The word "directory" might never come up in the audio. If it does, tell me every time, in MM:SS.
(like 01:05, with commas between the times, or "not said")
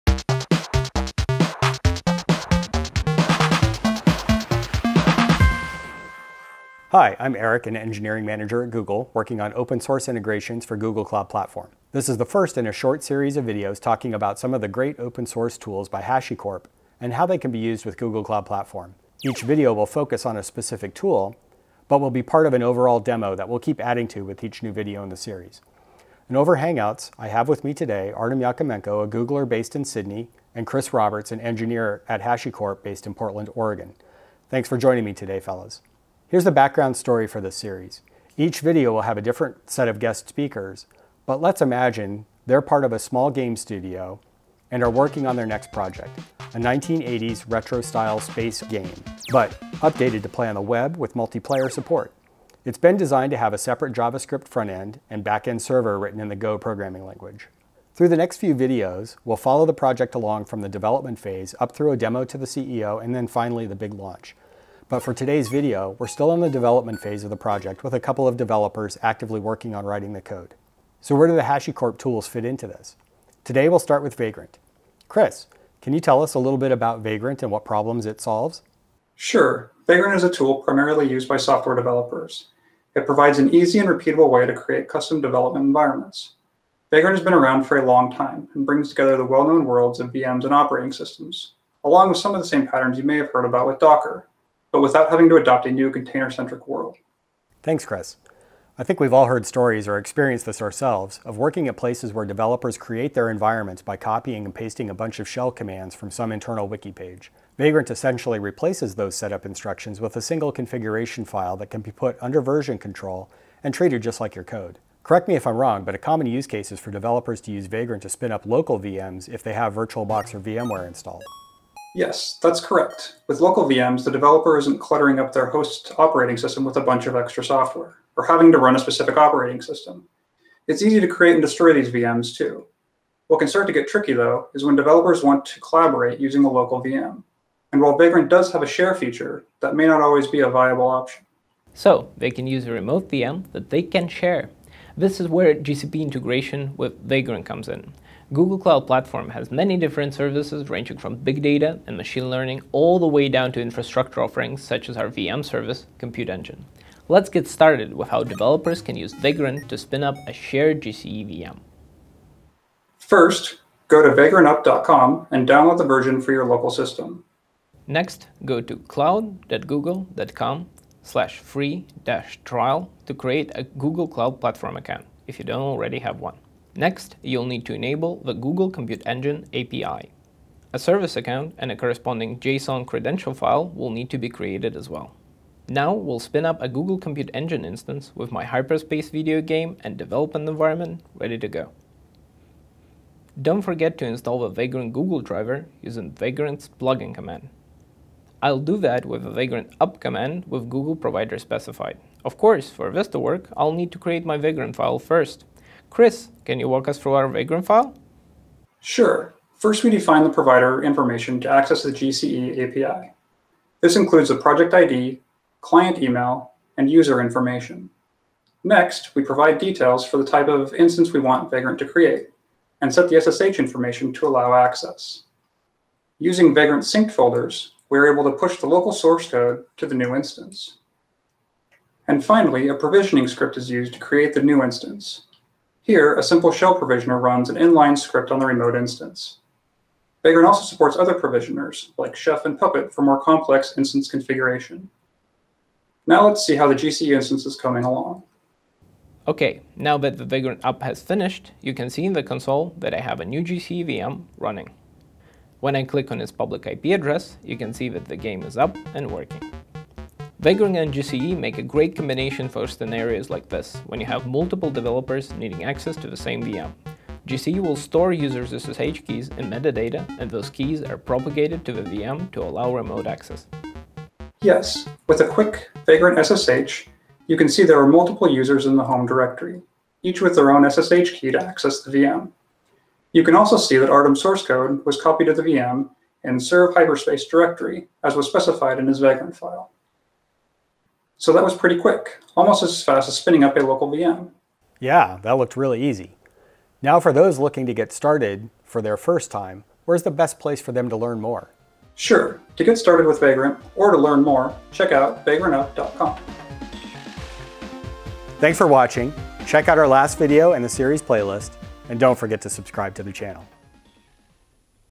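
04:39, 04:47.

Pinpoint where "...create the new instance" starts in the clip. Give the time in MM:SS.
03:53.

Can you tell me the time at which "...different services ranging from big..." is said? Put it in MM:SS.
02:29.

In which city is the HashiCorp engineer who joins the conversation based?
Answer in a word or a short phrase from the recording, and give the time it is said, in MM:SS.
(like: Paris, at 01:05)
Portland, Oregon, at 00:33.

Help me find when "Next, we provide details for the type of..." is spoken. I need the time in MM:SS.
03:38.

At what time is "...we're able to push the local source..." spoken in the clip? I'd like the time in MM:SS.
03:47.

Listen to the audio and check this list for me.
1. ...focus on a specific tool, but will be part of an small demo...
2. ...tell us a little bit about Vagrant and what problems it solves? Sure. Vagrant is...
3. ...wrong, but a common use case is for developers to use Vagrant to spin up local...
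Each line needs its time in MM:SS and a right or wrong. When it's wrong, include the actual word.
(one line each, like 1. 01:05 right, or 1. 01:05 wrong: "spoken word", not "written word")
1. 00:19 wrong: "overall", not "small"
2. 01:16 right
3. 01:55 right.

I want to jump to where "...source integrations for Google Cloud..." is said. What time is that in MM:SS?
00:09.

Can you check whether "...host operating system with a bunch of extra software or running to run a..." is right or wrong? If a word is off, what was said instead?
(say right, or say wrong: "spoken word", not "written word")
wrong: "having", not "running".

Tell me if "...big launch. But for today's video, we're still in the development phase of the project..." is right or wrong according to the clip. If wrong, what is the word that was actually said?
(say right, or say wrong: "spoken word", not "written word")
right.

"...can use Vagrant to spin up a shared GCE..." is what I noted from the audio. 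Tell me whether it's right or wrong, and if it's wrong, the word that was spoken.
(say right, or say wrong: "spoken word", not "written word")
right.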